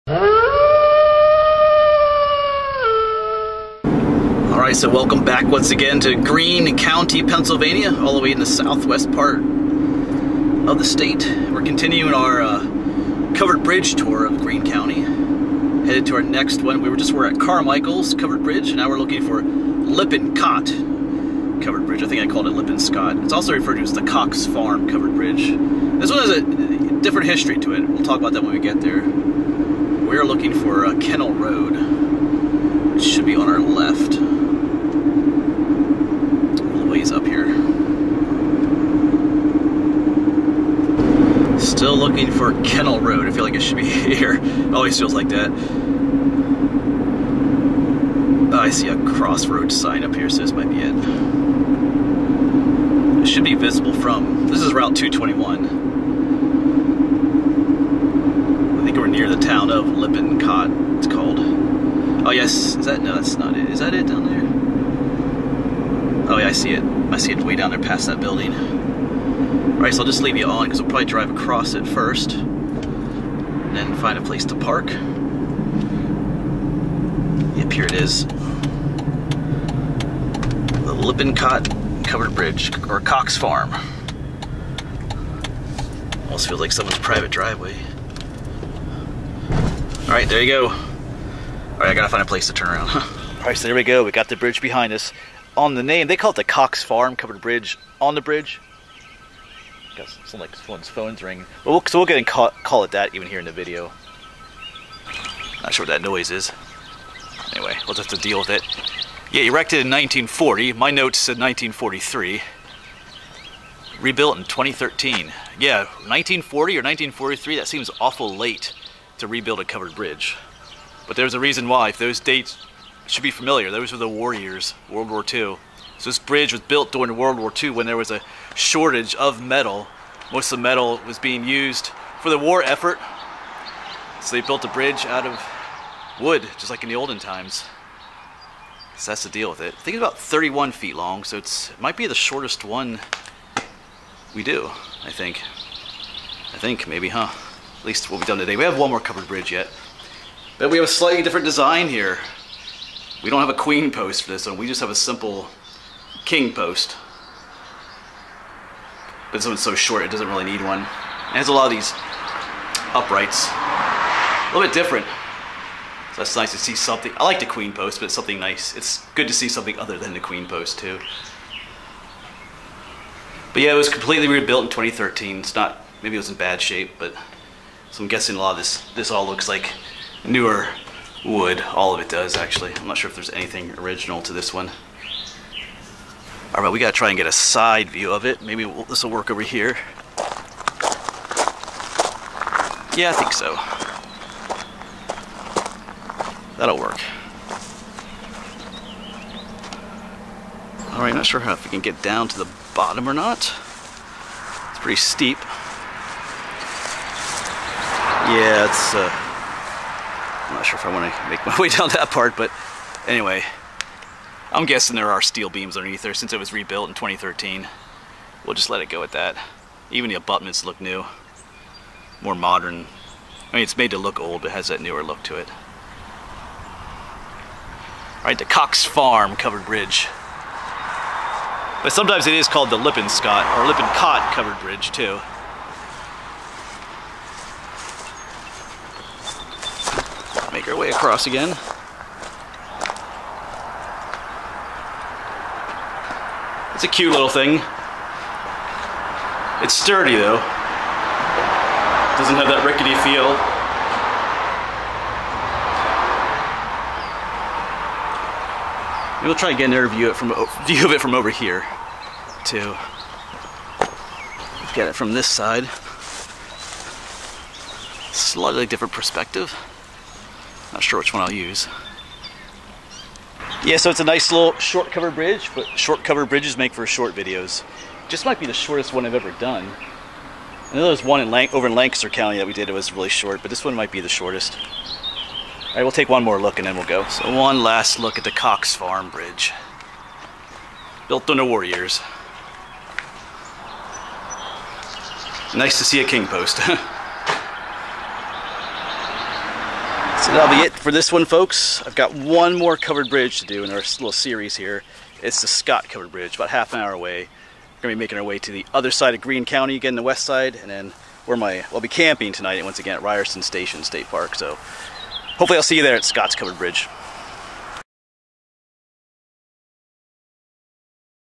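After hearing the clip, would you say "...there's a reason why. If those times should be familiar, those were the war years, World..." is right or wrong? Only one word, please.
wrong.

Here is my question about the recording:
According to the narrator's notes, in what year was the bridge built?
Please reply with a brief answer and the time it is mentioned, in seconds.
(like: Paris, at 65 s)
1943, at 110 s.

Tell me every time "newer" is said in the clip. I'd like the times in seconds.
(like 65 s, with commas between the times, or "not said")
180 s, 224 s.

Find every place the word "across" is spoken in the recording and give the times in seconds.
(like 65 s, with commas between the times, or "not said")
71 s, 240 s.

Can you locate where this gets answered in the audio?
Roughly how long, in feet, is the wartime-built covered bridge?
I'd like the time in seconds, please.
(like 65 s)
140 s.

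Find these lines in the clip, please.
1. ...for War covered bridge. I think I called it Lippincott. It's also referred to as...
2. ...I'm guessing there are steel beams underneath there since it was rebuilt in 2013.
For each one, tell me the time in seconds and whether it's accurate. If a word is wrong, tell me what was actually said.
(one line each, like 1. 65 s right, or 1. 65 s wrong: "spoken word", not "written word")
1. 19 s wrong: "Lippincott", not "War"
2. 214 s right.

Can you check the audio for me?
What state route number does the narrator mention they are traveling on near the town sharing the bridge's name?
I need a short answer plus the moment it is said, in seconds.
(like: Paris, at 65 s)
221, at 54 s.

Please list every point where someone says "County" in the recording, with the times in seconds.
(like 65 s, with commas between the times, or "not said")
6 s, 14 s, 282 s, 309 s.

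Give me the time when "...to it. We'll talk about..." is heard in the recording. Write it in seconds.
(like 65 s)
27 s.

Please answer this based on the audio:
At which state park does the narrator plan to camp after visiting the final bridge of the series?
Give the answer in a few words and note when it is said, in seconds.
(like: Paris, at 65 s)
Ryerson Station State Park, at 313 s.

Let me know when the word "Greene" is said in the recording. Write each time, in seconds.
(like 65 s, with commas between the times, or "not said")
6 s, 14 s, 309 s.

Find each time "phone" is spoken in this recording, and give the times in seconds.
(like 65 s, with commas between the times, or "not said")
100 s.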